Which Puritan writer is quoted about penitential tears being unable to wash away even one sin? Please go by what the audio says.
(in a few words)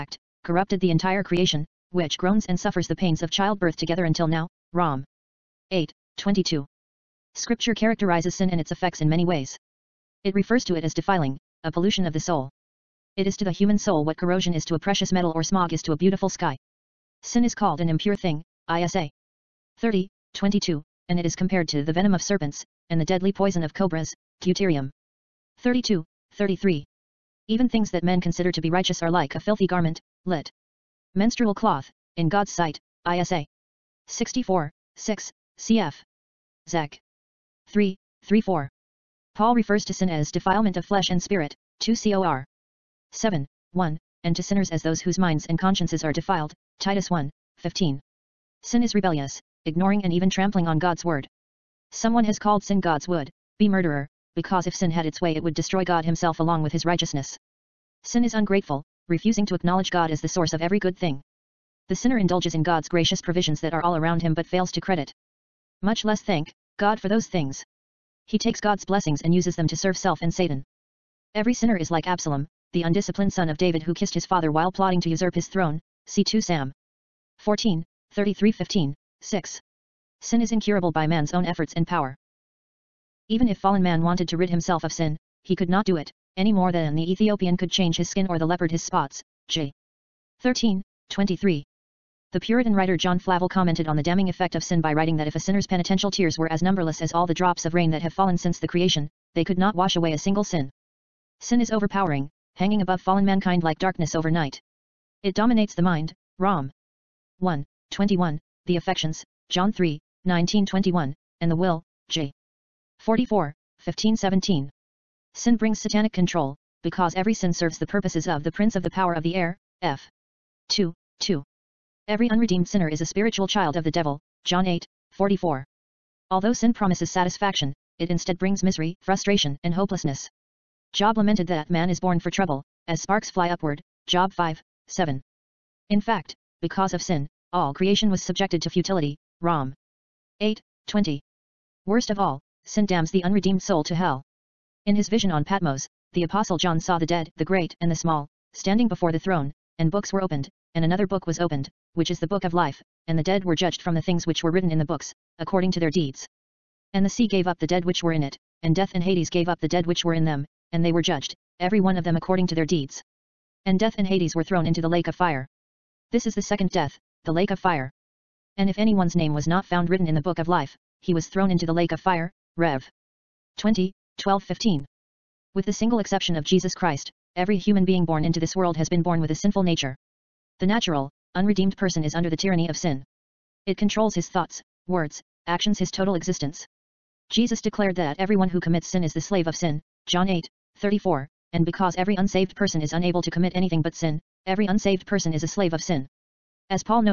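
John Flavel.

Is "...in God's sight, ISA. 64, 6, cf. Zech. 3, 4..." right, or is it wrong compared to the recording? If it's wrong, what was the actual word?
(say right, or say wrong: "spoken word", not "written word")
wrong: "3", not "4".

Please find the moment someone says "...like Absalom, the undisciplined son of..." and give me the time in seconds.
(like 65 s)
71 s.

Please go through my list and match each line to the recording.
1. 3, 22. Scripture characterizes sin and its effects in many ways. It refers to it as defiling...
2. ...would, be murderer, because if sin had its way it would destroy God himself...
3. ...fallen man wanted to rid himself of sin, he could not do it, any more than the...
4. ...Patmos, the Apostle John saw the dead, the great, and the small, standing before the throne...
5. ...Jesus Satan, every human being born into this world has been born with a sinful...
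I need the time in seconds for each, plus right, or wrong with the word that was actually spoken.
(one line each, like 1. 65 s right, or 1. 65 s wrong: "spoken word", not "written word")
1. 5 s wrong: "8", not "3"
2. 53 s right
3. 83 s right
4. 145 s right
5. 176 s wrong: "Christ", not "Satan".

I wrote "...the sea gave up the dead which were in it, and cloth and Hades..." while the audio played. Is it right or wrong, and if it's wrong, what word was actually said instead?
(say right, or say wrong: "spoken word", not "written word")
wrong: "death", not "cloth".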